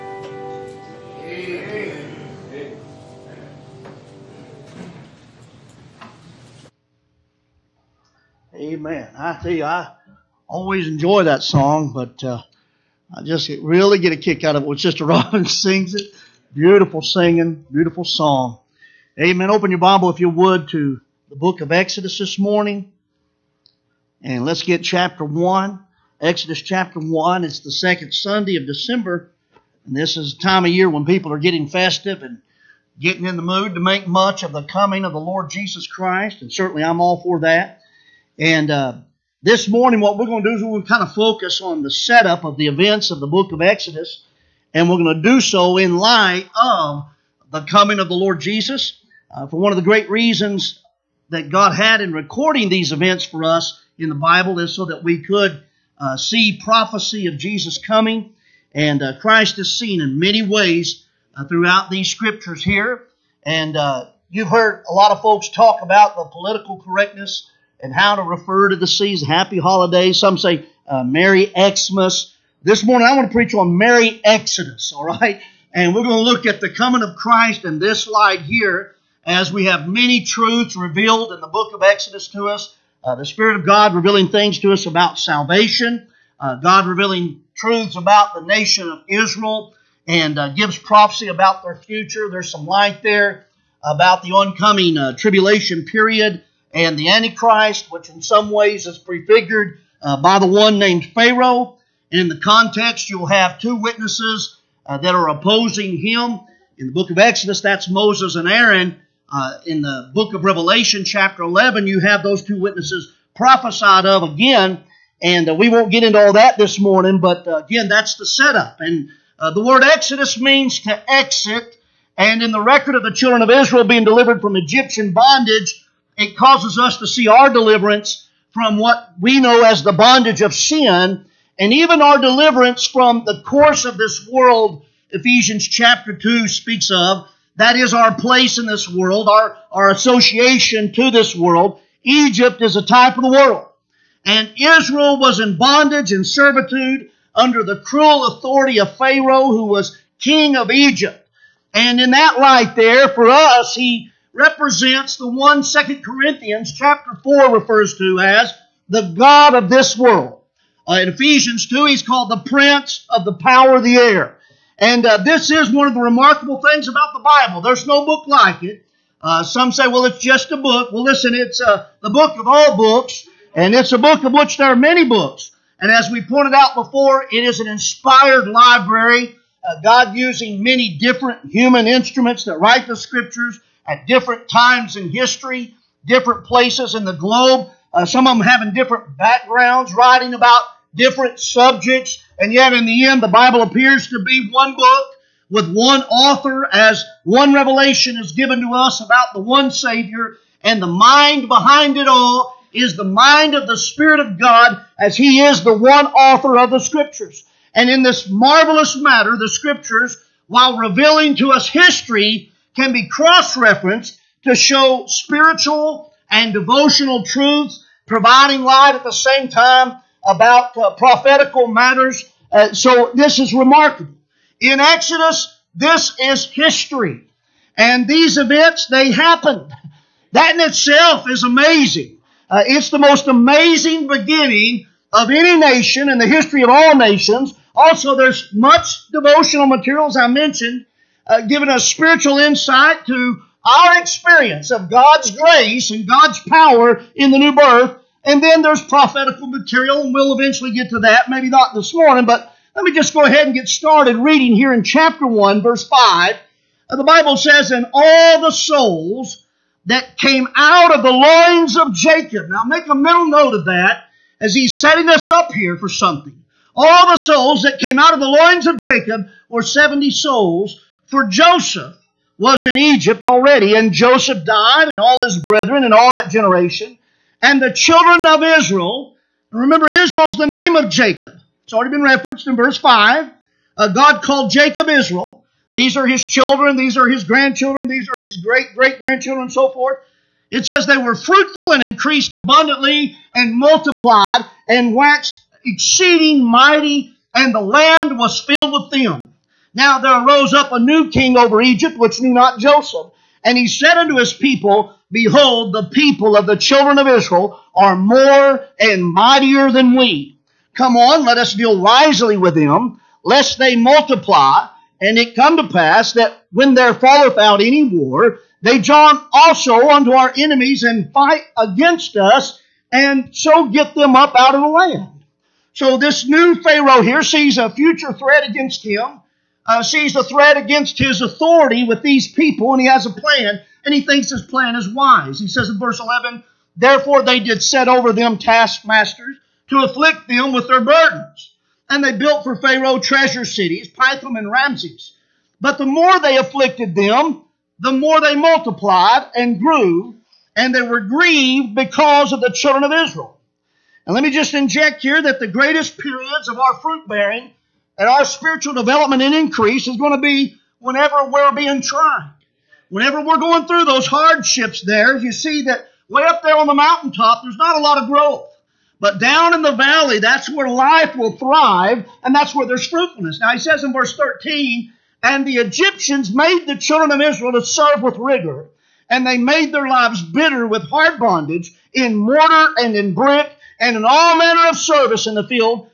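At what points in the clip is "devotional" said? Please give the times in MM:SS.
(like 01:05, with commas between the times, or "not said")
03:36, 03:59.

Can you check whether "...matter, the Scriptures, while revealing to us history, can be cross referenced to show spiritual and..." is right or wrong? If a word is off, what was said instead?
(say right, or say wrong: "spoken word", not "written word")
right.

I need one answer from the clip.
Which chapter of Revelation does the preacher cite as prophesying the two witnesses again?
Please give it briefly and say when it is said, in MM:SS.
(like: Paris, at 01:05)
Chapter 11, at 01:51.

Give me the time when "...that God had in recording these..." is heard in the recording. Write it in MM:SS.
00:51.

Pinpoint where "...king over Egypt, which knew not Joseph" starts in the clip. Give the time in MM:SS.
05:01.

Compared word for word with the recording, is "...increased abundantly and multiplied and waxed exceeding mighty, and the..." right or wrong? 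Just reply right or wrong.
right.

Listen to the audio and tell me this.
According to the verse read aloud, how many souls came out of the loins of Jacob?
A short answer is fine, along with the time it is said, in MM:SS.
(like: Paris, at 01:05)
70, at 04:29.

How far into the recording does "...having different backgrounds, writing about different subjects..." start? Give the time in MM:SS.
03:08.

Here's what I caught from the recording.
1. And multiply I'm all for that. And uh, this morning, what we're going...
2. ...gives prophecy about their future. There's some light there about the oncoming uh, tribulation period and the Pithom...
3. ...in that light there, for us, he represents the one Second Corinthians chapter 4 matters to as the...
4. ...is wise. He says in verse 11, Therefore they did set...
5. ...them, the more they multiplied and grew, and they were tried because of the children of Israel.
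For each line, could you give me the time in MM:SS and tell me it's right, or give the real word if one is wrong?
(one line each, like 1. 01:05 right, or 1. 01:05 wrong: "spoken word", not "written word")
1. 00:36 wrong: "certainly", not "multiply"
2. 01:30 wrong: "Antichrist", not "Pithom"
3. 02:31 wrong: "refers", not "matters"
4. 05:34 right
5. 05:46 wrong: "grieved", not "tried".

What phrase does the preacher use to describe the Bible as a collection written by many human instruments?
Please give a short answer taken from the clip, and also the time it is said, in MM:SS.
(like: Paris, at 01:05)
An inspired library, at 02:57.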